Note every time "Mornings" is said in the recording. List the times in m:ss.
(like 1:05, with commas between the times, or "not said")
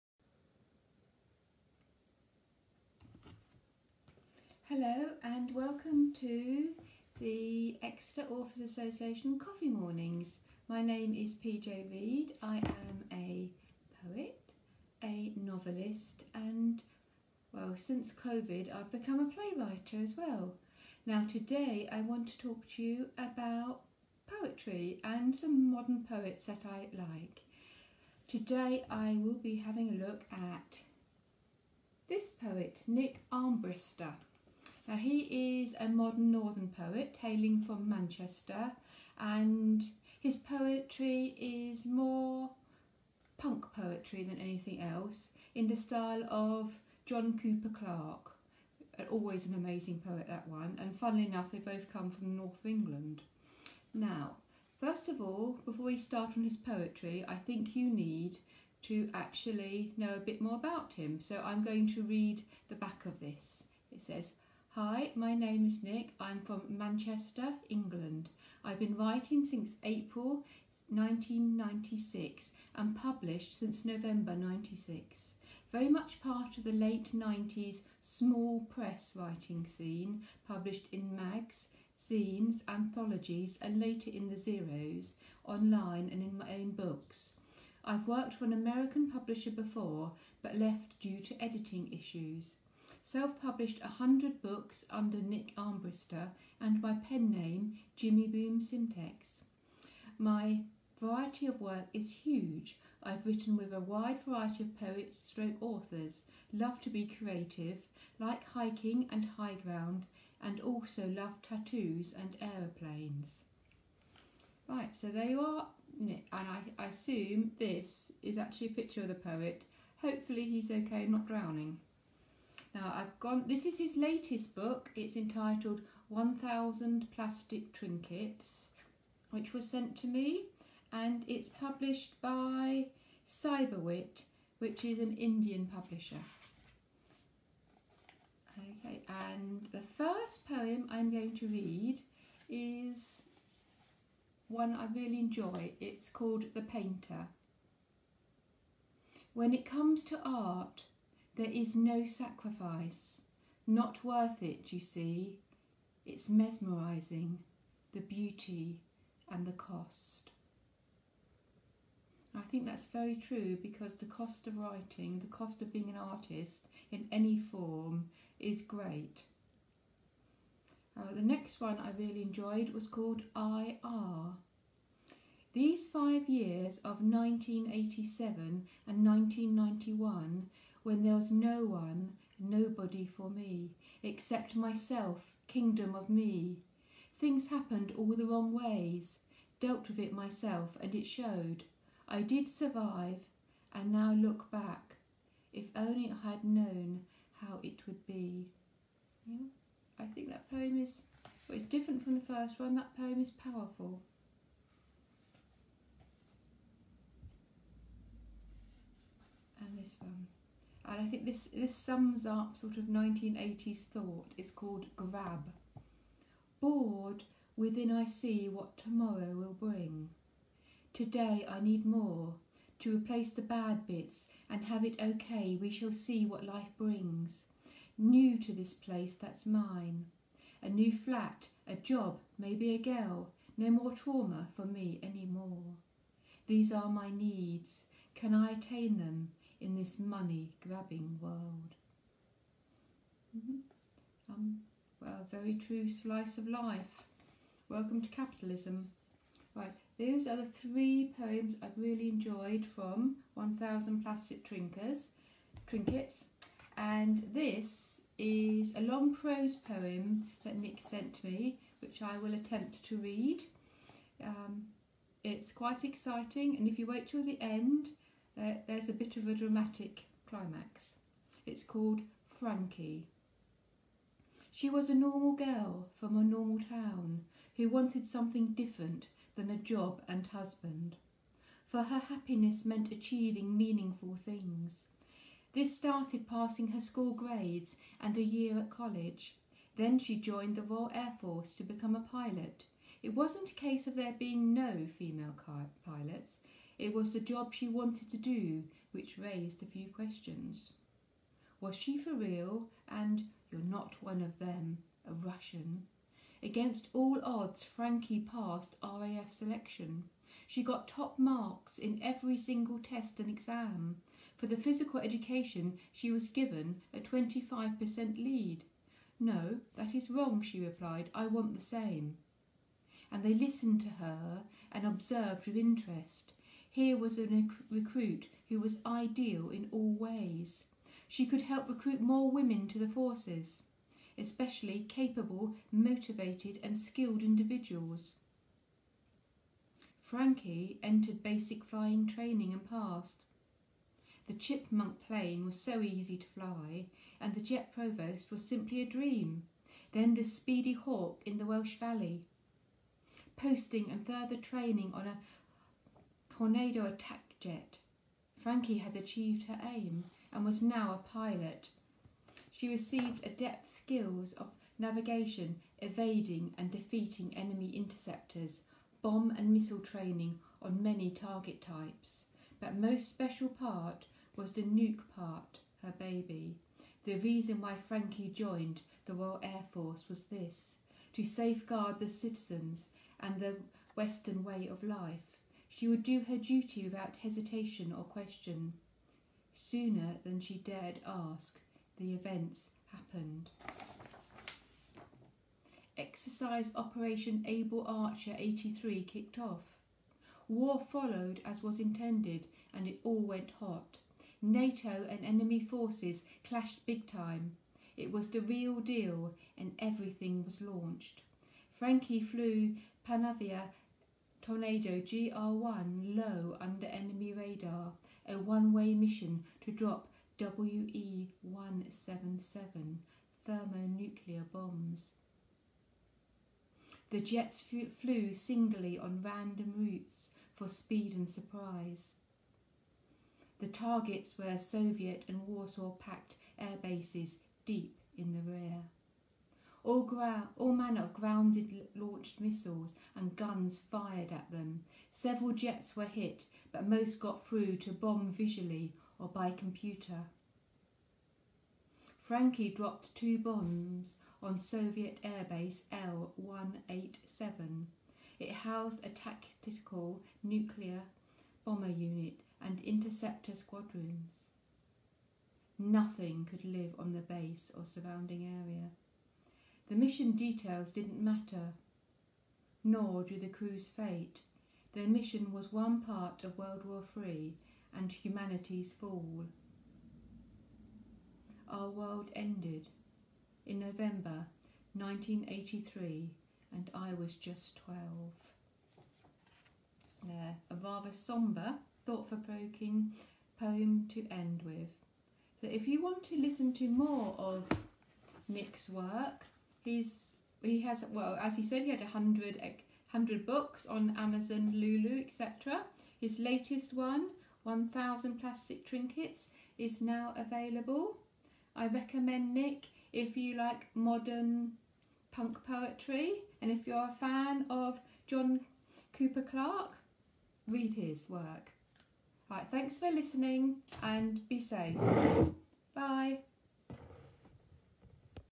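0:09.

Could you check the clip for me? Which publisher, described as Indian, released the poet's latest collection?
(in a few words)
Cyberwit.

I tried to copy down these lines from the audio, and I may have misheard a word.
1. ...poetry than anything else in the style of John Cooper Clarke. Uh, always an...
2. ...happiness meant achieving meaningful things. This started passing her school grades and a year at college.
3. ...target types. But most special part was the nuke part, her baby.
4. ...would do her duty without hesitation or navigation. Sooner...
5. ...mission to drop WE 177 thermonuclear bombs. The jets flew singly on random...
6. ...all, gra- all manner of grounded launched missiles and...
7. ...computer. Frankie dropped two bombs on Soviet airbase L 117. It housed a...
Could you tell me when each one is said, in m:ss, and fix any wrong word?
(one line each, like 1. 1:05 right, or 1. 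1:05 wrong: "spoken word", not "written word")
1. 0:43 right
2. 4:41 right
3. 6:11 right
4. 6:25 wrong: "question", not "navigation"
5. 6:58 right
6. 7:19 right
7. 7:29 wrong: "187", not "117".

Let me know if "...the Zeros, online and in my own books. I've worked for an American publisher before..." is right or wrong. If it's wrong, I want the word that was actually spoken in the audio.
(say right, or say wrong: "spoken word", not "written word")
right.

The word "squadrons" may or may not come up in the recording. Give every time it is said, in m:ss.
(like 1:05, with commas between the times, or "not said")
7:43.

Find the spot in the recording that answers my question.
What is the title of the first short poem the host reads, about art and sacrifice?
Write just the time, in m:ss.
2:26.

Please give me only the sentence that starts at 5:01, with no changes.
Was she for real and you're not one of them, a Russian?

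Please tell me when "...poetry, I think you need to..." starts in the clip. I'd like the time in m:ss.
0:56.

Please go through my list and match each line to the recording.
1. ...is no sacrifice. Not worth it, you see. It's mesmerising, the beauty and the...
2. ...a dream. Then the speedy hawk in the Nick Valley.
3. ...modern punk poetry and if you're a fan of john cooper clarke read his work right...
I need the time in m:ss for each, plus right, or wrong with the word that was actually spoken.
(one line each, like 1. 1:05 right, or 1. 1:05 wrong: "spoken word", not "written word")
1. 2:31 right
2. 5:48 wrong: "Welsh", not "Nick"
3. 8:33 right.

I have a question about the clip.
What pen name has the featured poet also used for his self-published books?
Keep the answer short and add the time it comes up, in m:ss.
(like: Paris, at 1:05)
Jimmy Boom Semtex, at 1:37.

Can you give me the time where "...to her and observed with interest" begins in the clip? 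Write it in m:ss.
5:23.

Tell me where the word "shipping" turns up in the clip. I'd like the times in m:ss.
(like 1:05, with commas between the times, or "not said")
not said.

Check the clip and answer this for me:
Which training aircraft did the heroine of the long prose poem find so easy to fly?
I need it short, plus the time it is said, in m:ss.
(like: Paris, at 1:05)
Chipmunk, at 5:44.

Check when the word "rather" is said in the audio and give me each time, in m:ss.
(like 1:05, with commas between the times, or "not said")
8:10.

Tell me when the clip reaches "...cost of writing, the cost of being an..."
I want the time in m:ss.
2:44.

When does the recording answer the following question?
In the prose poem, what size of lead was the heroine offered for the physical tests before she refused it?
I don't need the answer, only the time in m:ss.
5:16.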